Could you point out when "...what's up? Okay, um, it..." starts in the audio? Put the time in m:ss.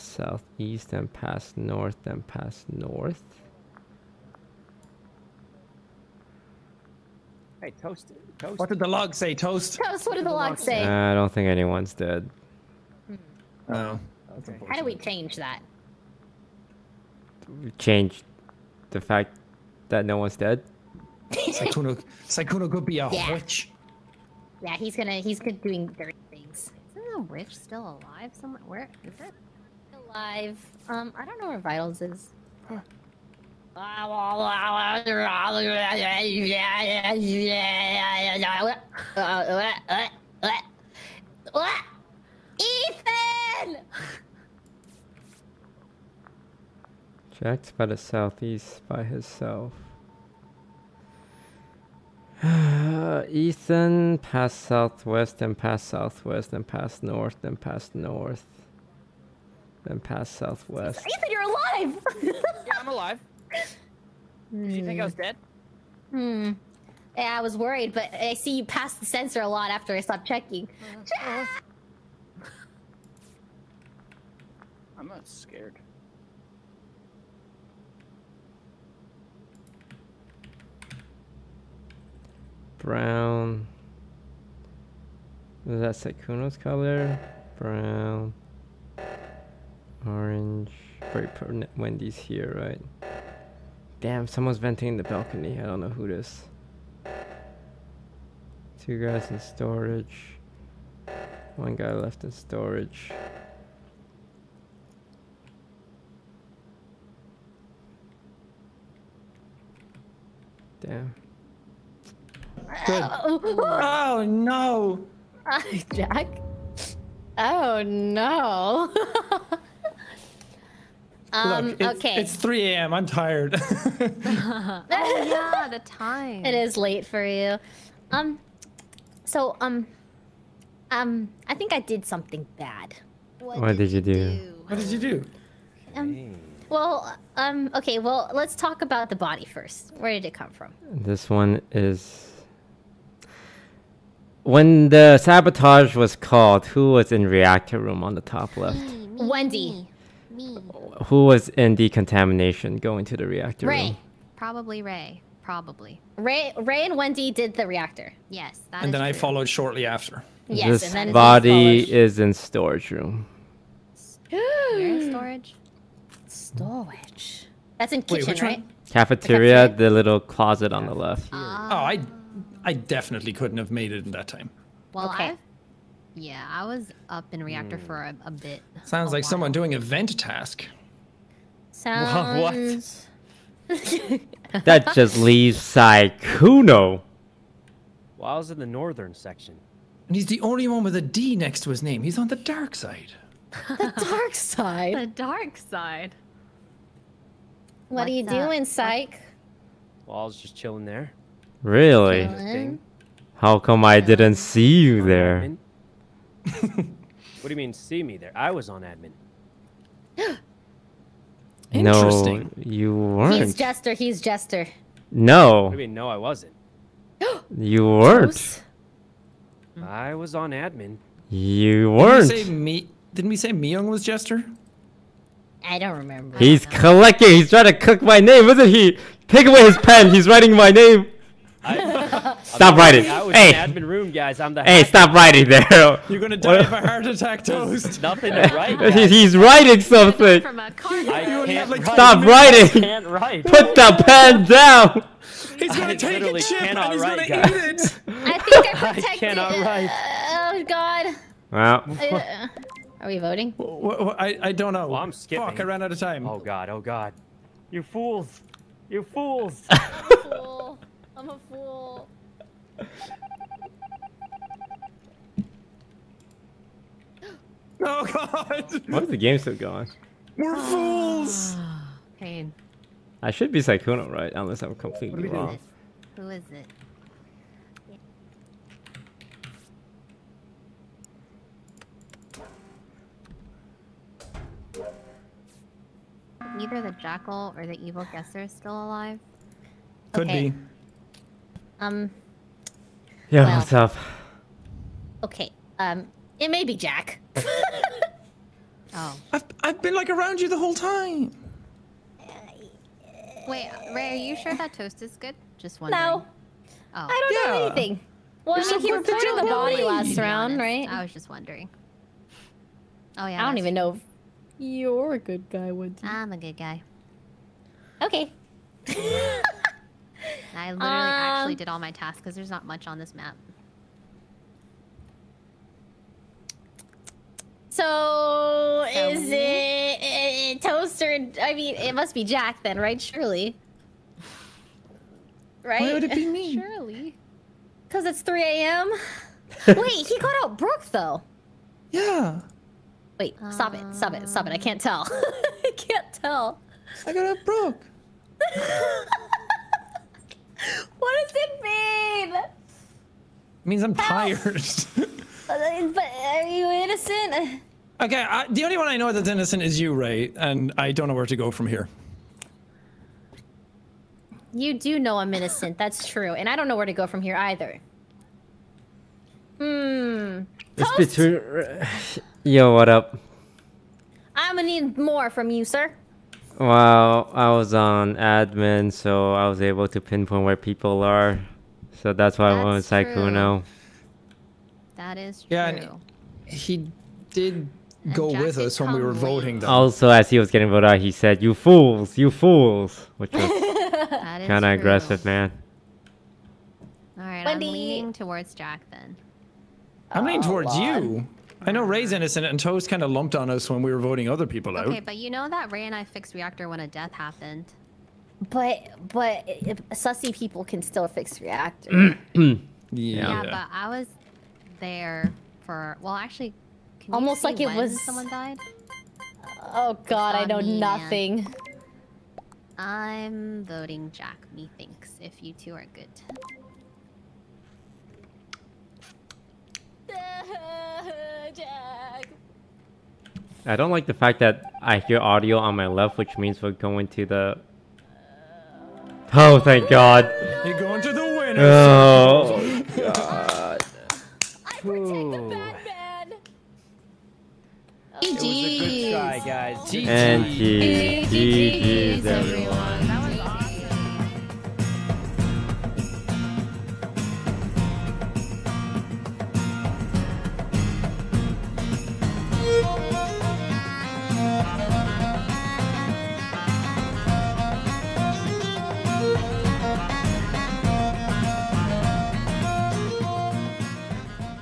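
4:53.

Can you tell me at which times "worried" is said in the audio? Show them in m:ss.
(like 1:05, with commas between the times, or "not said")
1:07.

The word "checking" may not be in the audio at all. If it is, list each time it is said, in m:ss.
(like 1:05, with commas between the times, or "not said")
1:10.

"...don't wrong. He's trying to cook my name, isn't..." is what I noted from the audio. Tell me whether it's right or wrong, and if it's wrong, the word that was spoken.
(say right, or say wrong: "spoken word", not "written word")
wrong: "collecting", not "wrong".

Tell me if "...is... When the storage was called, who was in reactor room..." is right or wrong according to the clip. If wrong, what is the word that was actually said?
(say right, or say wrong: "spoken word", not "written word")
wrong: "sabotage", not "storage".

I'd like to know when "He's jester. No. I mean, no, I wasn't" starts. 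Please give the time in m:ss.
3:33.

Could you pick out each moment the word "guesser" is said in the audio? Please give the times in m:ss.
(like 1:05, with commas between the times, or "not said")
4:48.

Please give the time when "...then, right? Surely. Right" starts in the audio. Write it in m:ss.
5:32.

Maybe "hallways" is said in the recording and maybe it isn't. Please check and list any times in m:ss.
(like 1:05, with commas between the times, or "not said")
not said.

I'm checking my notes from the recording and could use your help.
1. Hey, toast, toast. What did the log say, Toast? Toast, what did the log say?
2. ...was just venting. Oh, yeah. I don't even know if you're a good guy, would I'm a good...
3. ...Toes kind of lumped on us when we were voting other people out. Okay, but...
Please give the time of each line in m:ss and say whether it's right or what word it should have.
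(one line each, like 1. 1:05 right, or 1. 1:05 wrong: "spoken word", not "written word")
1. 0:07 right
2. 5:11 wrong: "wondering", not "venting"
3. 6:42 right.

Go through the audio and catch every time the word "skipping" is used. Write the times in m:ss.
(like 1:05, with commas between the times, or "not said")
4:15.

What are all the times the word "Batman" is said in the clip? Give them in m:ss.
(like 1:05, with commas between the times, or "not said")
7:25.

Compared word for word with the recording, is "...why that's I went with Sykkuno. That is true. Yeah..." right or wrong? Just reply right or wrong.
right.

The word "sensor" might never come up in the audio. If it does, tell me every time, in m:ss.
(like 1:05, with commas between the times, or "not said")
1:09.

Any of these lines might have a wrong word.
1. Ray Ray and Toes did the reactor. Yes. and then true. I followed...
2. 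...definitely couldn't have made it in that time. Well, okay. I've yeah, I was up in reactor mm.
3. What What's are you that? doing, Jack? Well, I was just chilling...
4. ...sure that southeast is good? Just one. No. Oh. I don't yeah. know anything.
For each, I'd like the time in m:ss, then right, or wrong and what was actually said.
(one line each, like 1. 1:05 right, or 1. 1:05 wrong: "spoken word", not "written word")
1. 2:36 wrong: "Wendy", not "Toes"
2. 2:52 right
3. 3:17 wrong: "Psych", not "Jack"
4. 5:04 wrong: "toast", not "southeast".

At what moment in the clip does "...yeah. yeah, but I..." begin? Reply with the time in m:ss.
6:52.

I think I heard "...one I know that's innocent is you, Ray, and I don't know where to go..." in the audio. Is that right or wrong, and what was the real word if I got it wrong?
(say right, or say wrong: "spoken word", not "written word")
right.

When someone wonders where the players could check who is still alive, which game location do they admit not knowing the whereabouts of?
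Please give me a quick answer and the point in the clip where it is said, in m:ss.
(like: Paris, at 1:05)
Vitals, at 0:31.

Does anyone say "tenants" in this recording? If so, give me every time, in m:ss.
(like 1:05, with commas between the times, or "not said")
not said.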